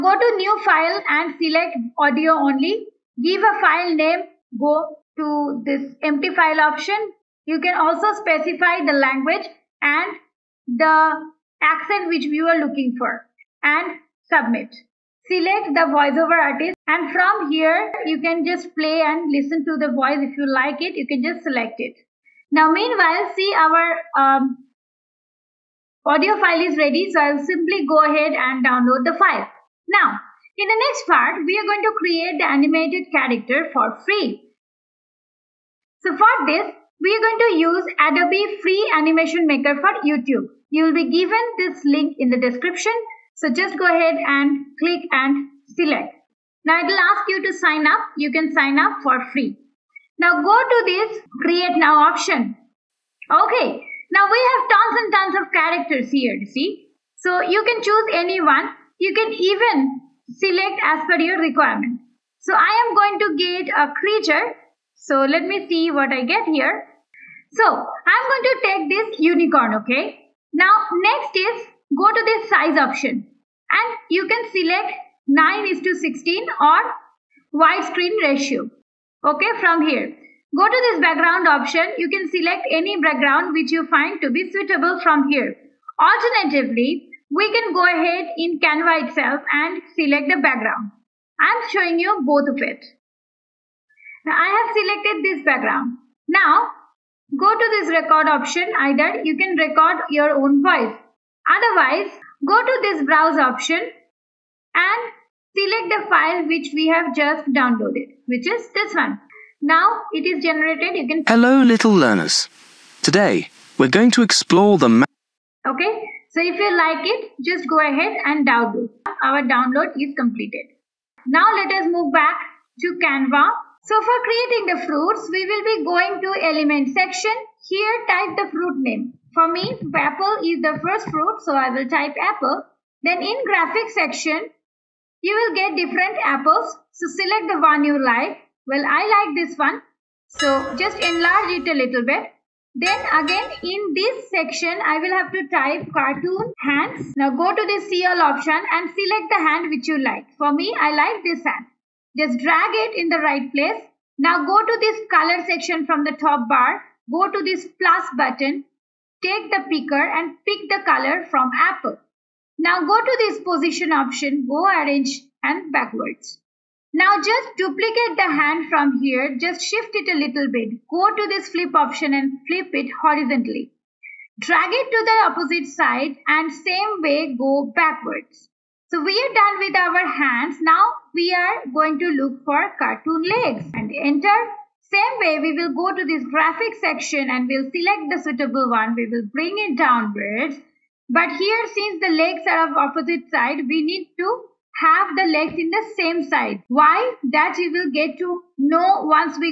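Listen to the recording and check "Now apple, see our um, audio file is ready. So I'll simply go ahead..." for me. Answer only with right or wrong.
wrong.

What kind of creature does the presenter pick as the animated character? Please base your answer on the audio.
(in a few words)
Unicorn.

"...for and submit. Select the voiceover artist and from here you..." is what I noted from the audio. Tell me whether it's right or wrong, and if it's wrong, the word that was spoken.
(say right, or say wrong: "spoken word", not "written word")
right.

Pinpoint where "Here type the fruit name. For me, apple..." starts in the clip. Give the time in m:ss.
2:07.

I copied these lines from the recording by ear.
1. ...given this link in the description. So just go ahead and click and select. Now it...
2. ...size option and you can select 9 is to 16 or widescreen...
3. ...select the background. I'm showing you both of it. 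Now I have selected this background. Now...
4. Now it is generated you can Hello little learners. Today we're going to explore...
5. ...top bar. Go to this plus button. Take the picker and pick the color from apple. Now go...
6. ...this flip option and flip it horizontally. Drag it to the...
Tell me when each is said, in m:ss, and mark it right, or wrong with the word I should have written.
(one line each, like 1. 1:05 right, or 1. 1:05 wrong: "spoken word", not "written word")
1. 0:41 right
2. 1:12 right
3. 1:29 right
4. 1:49 right
5. 2:36 right
6. 2:51 right.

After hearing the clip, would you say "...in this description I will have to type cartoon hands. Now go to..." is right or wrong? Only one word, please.
wrong.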